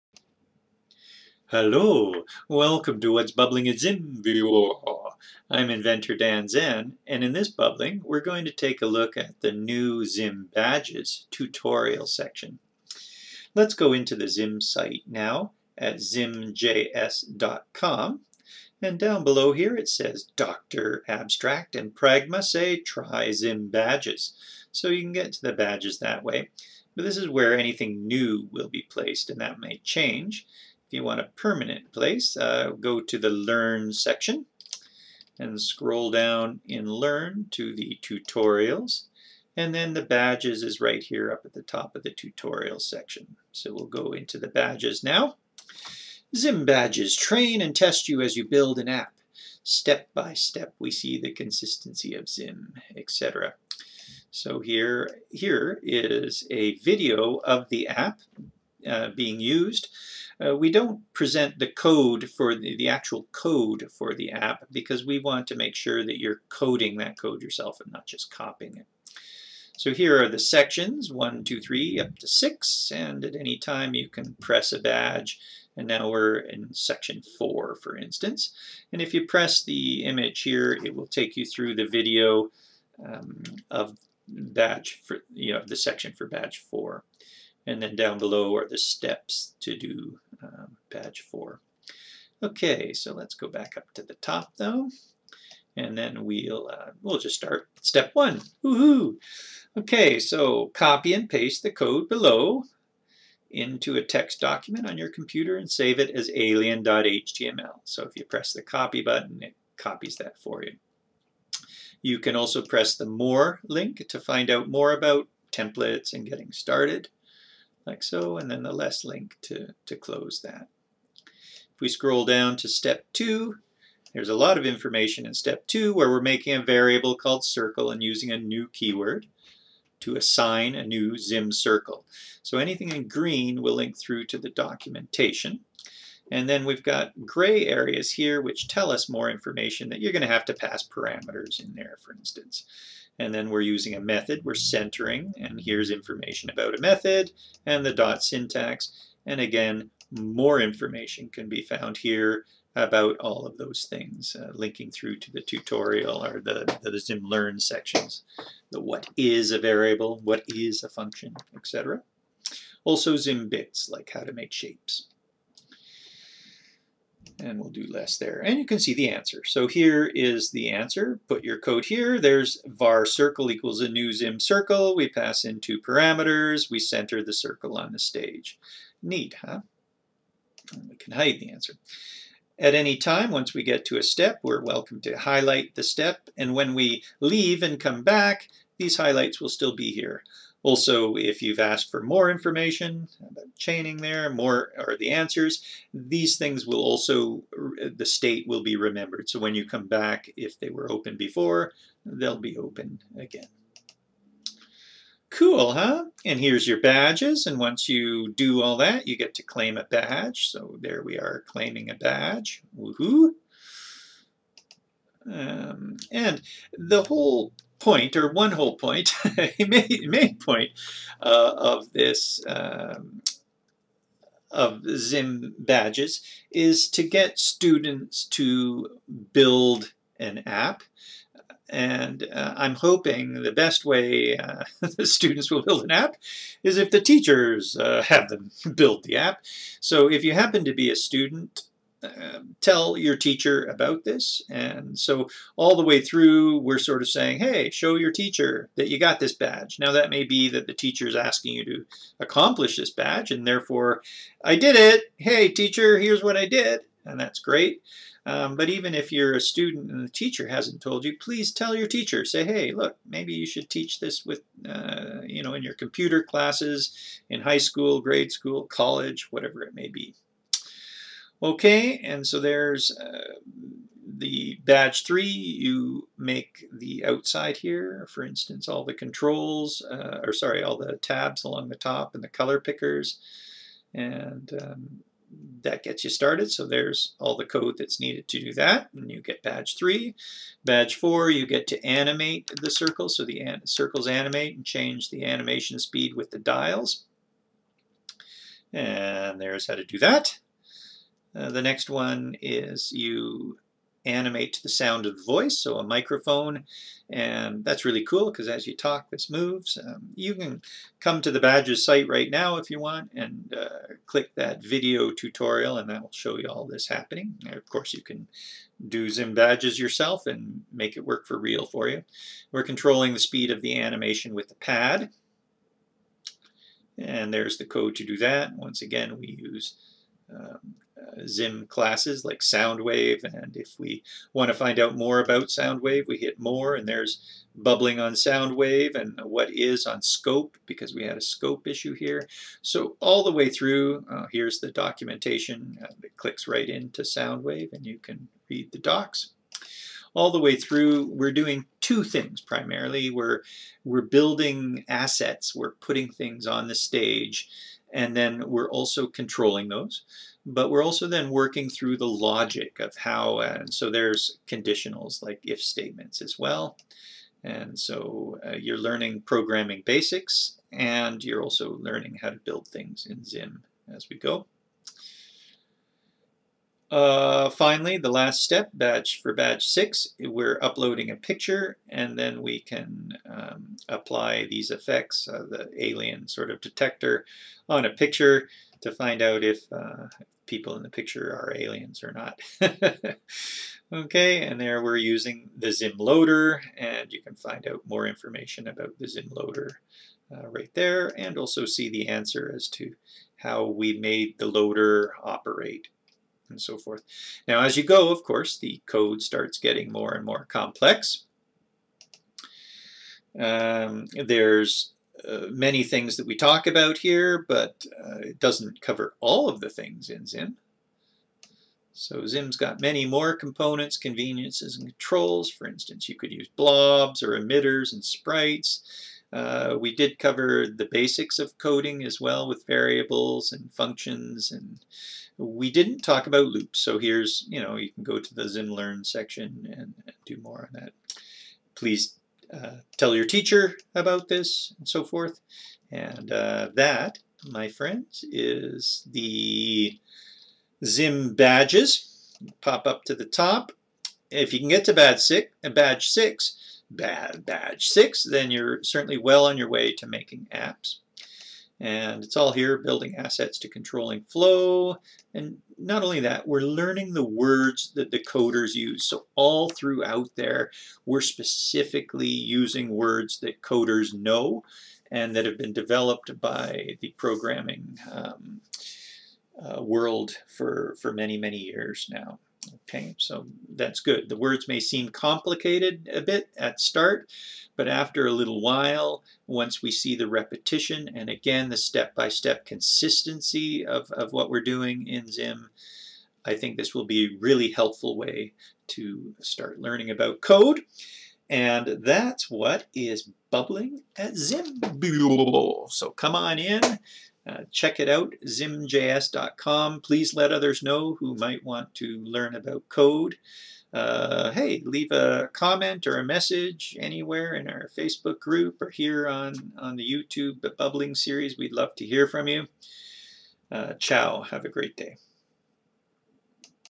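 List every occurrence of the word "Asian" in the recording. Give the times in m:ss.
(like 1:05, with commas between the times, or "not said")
not said.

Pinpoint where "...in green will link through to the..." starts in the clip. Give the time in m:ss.
2:12.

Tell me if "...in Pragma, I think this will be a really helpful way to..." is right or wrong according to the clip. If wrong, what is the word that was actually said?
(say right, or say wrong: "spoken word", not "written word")
wrong: "Zim", not "Pragma".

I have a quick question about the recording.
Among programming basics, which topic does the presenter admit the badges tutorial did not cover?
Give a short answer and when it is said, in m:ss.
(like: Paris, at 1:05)
loops, at 7:16.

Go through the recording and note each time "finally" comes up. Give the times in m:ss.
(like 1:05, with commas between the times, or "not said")
6:17.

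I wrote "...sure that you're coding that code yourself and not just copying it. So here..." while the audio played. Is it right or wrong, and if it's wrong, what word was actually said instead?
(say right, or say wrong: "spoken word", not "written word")
right.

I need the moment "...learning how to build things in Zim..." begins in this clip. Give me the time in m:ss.
6:11.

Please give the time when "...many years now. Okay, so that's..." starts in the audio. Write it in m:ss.
8:01.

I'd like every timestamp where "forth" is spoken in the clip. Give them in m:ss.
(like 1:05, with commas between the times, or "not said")
6:46, 7:25.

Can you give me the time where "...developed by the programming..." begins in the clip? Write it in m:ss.
7:55.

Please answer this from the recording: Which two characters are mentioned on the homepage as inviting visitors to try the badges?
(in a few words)
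Dr. Abstract and Pragma.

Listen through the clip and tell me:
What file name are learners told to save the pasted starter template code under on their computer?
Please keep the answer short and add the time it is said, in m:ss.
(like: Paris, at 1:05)
alien.html, at 1:46.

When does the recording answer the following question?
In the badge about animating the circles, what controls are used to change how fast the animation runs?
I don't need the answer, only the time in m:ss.
4:56.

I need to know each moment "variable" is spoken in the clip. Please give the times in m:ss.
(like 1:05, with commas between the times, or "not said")
2:06, 2:39, 7:12.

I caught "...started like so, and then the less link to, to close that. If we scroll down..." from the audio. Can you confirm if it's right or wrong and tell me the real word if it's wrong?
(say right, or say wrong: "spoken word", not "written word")
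right.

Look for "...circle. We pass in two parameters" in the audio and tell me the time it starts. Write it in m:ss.
2:54.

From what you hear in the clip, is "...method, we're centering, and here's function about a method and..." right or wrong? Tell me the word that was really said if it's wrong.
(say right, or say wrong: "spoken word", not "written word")
wrong: "information", not "function".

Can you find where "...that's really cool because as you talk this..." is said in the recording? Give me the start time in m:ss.
5:07.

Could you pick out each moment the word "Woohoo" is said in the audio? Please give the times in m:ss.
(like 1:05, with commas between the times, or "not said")
1:38, 3:32.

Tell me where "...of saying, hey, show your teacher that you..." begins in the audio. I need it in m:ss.
4:07.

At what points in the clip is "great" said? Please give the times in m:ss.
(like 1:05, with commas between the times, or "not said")
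4:17, 8:44.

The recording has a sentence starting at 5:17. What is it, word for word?
And of course you can do Zim Badges yourself and make it work for real for you.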